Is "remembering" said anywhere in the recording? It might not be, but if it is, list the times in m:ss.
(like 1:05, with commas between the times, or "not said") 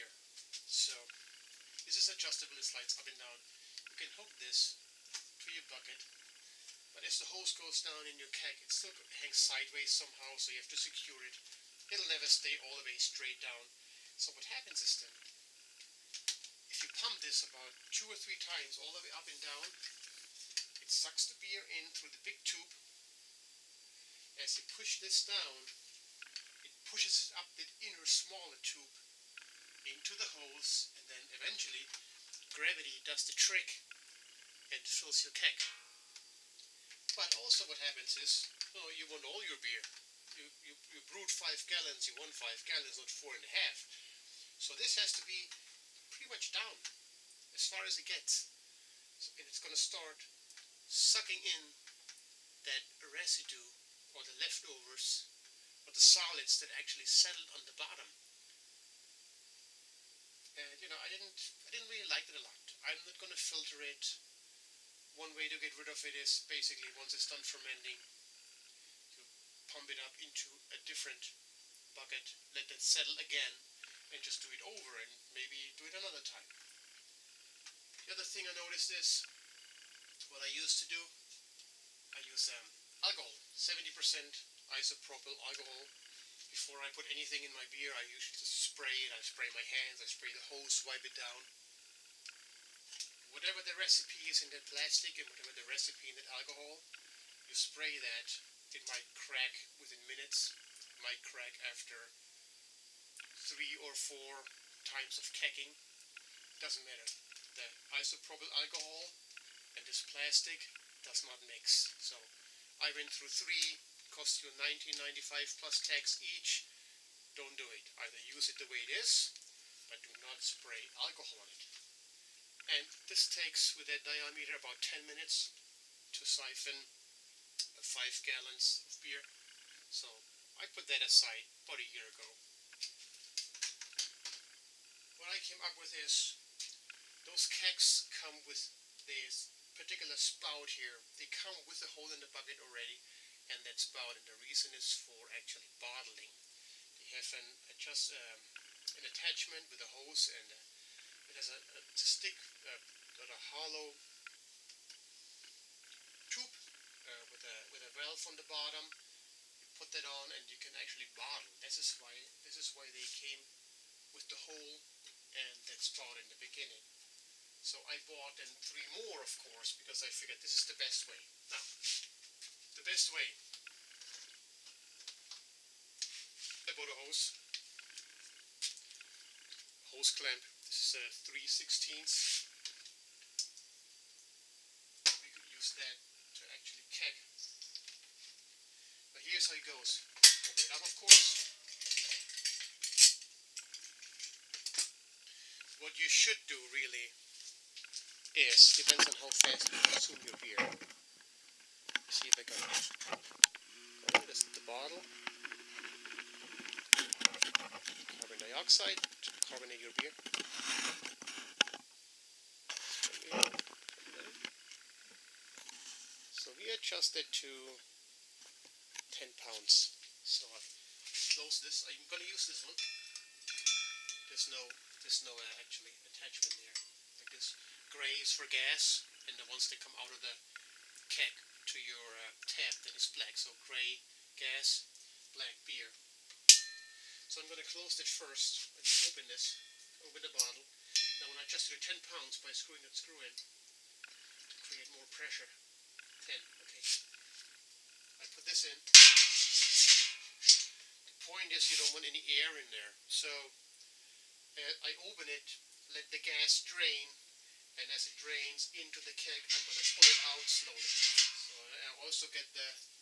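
not said.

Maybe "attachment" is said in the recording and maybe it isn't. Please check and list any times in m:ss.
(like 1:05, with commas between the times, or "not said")
2:29, 3:46.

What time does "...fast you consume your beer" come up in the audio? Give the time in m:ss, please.
3:19.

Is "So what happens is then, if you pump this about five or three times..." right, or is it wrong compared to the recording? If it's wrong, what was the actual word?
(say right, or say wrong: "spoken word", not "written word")
wrong: "two", not "five".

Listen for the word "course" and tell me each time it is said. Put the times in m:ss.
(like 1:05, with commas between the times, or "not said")
2:49, 3:10.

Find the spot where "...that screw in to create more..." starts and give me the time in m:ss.
4:02.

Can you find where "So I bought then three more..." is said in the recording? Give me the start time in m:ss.
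2:47.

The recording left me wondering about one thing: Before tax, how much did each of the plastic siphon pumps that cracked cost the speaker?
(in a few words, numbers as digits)
$19.95.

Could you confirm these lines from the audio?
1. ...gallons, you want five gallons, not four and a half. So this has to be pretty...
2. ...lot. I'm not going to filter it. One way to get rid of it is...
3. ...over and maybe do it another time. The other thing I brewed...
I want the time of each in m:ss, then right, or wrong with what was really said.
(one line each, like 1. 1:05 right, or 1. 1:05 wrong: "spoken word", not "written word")
1. 0:41 right
2. 1:02 right
3. 1:14 wrong: "noticed", not "brewed".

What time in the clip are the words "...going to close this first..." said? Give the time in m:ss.
3:57.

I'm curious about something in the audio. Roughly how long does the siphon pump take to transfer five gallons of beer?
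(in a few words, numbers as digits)
10 minutes.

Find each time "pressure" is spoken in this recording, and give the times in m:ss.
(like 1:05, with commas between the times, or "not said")
4:05.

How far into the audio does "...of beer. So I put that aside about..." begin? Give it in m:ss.
2:08.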